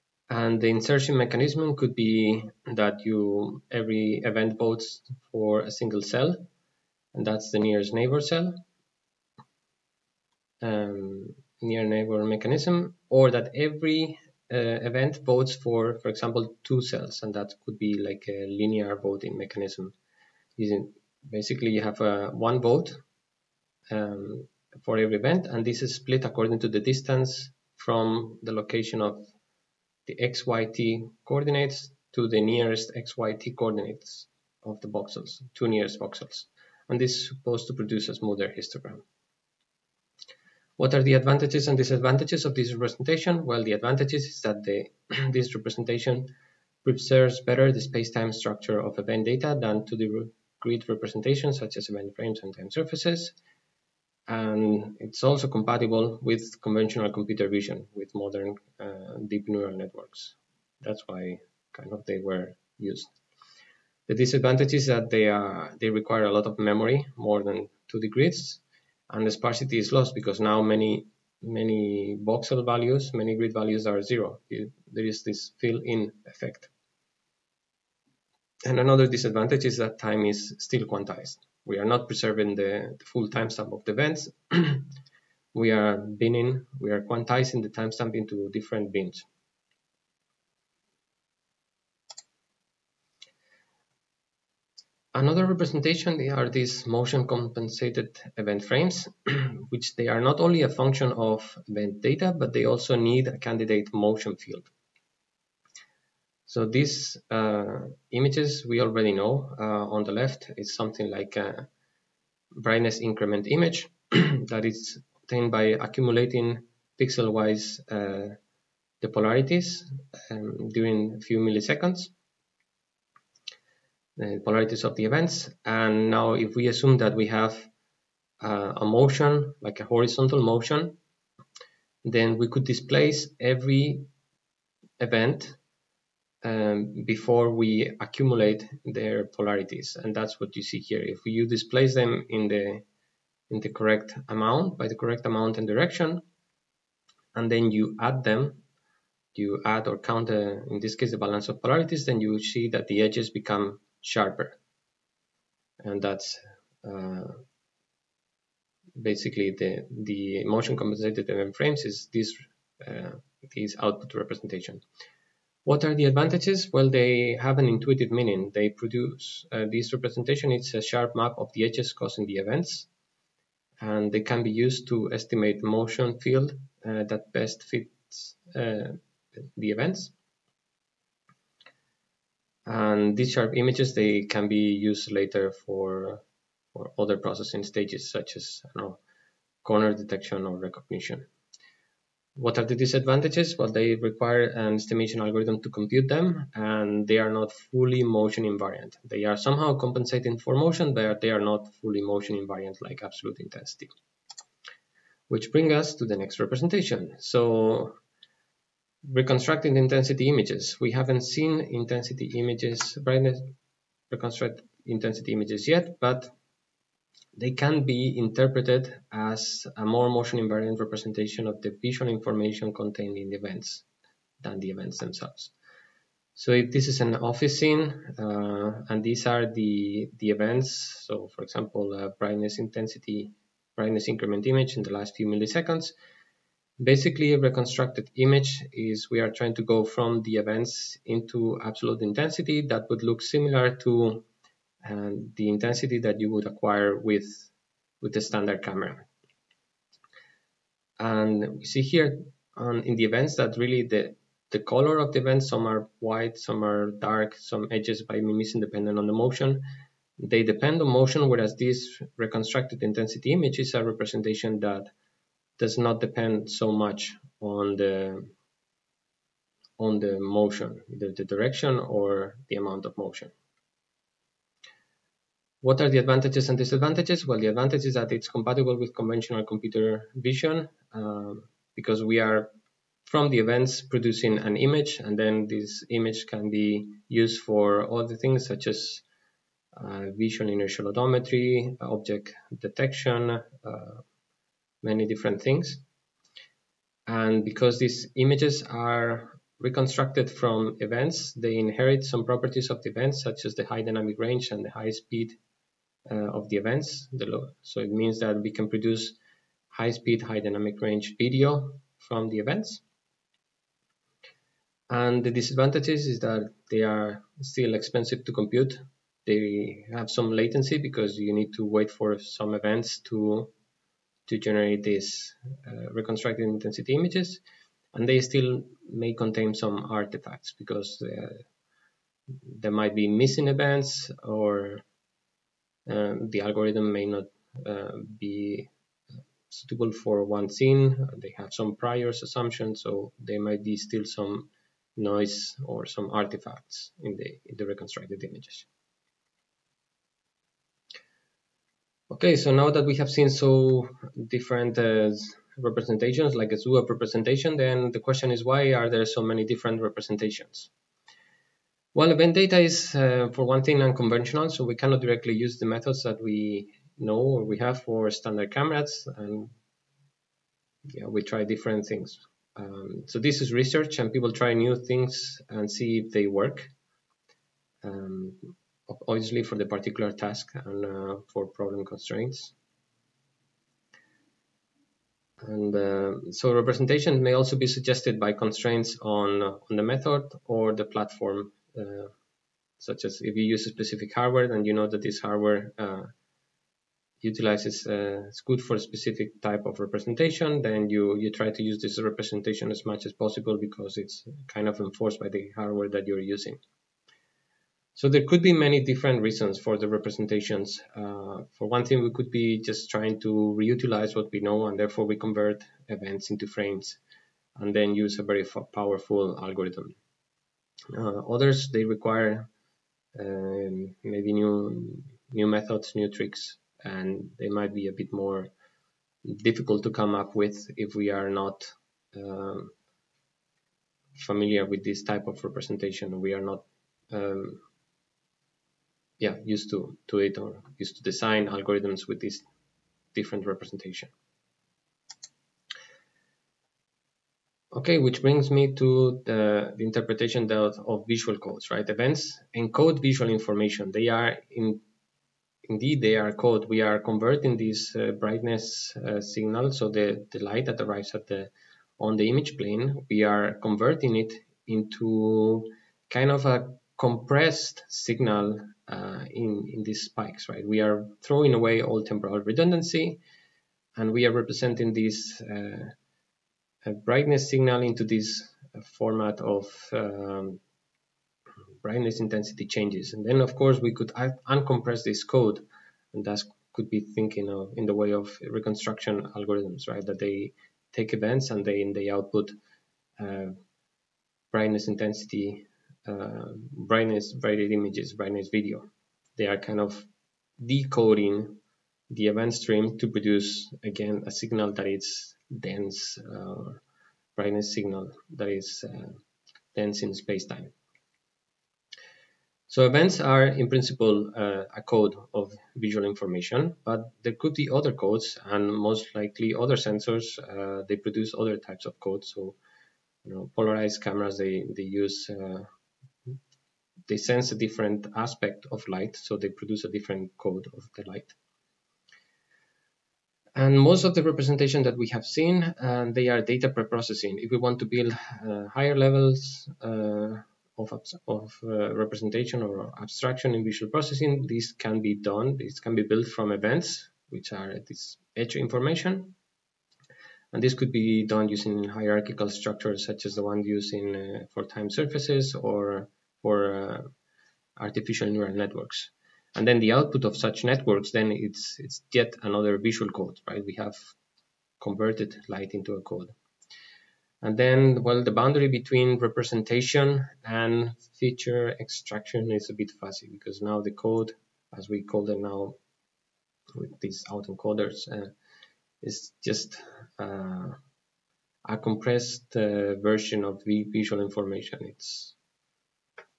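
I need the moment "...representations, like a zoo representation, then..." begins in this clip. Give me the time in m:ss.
5:55.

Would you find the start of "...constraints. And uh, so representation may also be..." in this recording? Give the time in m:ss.
6:21.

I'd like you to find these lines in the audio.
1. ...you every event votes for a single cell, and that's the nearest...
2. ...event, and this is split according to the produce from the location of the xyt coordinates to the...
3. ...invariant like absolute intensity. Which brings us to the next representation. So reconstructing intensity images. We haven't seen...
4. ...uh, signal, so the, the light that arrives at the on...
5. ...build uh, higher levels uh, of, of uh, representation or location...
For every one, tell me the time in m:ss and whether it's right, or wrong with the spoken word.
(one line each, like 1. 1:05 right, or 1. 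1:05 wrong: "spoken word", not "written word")
1. 0:03 right
2. 0:25 wrong: "distance", not "produce"
3. 3:22 right
4. 7:38 right
5. 8:57 wrong: "abstraction", not "location".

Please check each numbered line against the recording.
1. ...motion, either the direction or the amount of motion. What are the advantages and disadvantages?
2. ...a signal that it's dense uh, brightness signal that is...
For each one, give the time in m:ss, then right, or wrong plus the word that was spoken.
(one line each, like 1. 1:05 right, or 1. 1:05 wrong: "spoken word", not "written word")
1. 4:30 right
2. 8:24 right.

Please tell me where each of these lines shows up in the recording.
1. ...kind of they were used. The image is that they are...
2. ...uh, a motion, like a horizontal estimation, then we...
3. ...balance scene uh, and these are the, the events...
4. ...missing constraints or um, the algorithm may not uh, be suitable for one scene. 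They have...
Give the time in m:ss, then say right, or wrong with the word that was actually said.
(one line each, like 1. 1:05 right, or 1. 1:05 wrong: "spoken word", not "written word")
1. 1:01 wrong: "disadvantage", not "image"
2. 2:08 wrong: "motion", not "estimation"
3. 3:47 wrong: "office", not "balance"
4. 5:33 wrong: "events", not "constraints".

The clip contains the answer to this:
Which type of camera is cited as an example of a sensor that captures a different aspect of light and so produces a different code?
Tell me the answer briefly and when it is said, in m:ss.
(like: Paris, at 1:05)
Polarized cameras, at 8:43.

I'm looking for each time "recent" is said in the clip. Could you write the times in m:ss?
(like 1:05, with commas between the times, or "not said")
not said.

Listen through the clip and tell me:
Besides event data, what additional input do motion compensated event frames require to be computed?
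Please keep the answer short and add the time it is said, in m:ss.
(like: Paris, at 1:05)
A candidate motion field, at 1:43.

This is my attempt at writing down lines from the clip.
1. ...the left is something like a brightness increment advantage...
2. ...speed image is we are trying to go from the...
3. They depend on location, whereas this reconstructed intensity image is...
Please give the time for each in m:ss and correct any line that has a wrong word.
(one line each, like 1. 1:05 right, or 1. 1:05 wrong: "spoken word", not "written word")
1. 1:50 wrong: "image", not "advantage"
2. 3:57 wrong: "reconstructed", not "speed"
3. 4:20 wrong: "motion", not "location".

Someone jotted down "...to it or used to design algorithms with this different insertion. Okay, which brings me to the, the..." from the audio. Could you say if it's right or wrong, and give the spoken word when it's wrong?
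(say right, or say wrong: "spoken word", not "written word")
wrong: "representation", not "insertion".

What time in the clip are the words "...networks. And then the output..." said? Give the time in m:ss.
9:18.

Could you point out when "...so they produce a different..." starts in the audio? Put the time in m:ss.
8:49.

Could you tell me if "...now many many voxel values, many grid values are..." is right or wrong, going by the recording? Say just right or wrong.
right.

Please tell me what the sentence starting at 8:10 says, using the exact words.
That they take events and they they output uh, brightness intensity, uh, brightness brighted images, brightness video.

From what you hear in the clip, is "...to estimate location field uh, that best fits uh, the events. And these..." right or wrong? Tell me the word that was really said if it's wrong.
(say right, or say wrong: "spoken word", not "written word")
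wrong: "motion", not "location".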